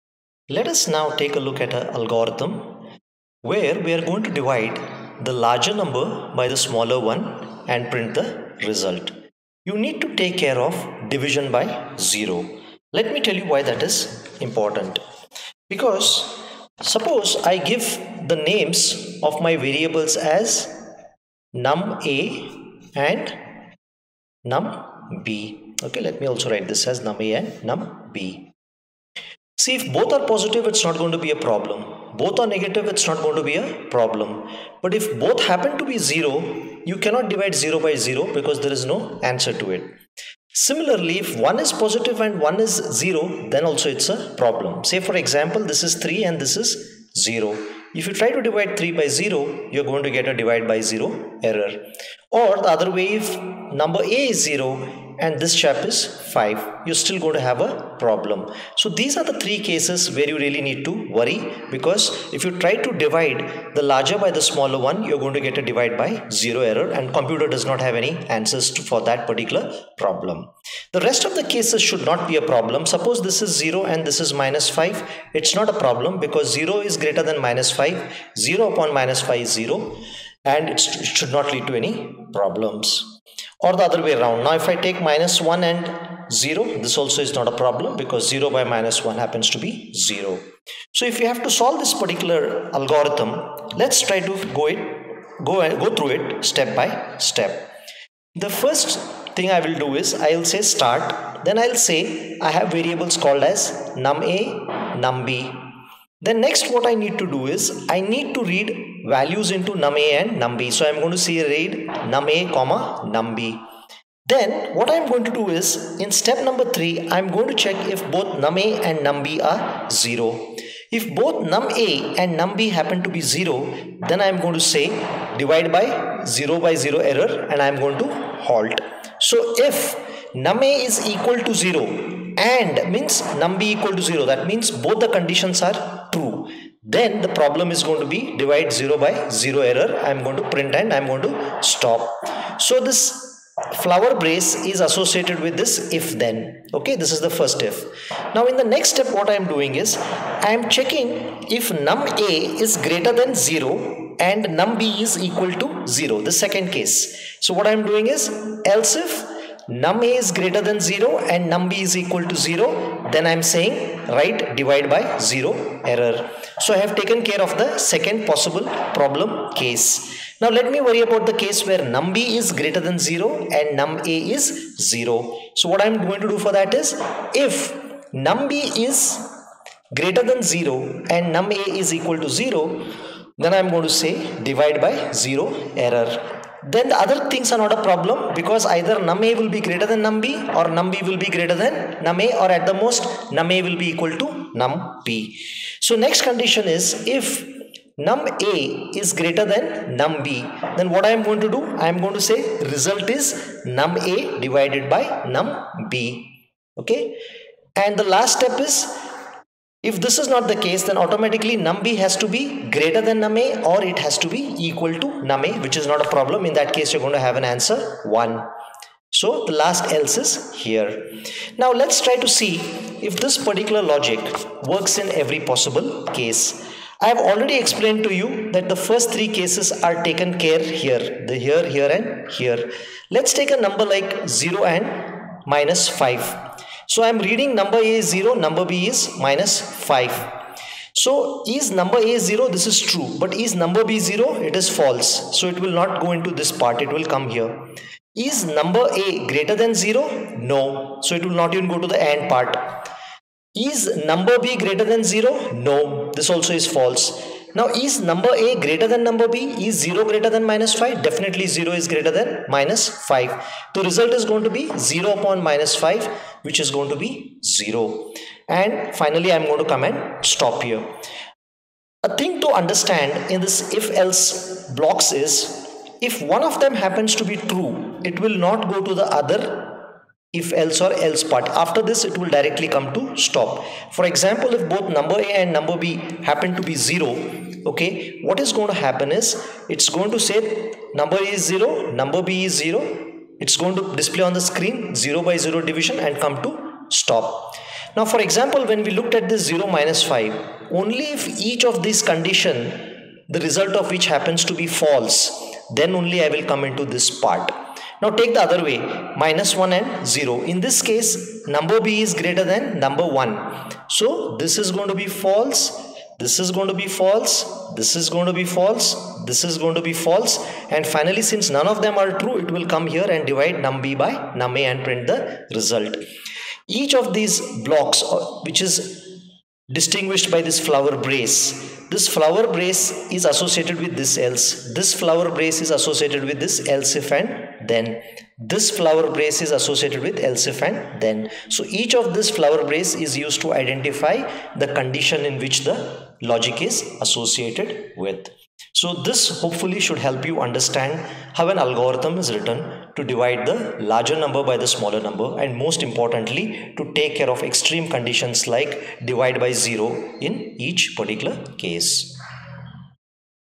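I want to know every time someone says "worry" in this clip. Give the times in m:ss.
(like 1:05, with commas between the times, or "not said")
1:01, 2:50.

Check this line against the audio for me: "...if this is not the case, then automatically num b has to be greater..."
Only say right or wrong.
right.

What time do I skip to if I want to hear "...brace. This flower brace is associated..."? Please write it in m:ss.
5:30.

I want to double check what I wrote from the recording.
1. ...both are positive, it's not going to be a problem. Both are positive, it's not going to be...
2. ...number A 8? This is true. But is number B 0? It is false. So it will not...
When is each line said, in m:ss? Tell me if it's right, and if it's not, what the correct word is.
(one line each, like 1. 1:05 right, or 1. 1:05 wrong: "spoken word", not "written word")
1. 0:29 wrong: "negative", not "positive"
2. 4:01 wrong: "0", not "8".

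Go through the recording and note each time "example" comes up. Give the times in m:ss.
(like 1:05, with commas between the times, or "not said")
0:45, 4:44, 4:58.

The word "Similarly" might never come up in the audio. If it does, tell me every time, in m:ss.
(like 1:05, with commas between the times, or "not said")
0:40.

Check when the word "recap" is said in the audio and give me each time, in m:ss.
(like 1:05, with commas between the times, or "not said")
not said.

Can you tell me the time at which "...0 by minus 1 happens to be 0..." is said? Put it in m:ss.
1:28.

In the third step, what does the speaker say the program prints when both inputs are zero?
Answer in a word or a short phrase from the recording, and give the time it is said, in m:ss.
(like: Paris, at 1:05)
divide 0 by 0 error, at 2:18.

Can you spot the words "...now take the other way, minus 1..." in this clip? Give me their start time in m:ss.
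5:08.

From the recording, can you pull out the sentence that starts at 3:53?
Let's take a number like 0 and minus 5.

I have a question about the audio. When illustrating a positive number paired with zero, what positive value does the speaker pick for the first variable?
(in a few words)
3.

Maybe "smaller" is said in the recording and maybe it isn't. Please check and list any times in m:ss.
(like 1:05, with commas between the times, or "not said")
0:06, 1:04, 5:54.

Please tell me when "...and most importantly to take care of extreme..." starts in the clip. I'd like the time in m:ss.
5:55.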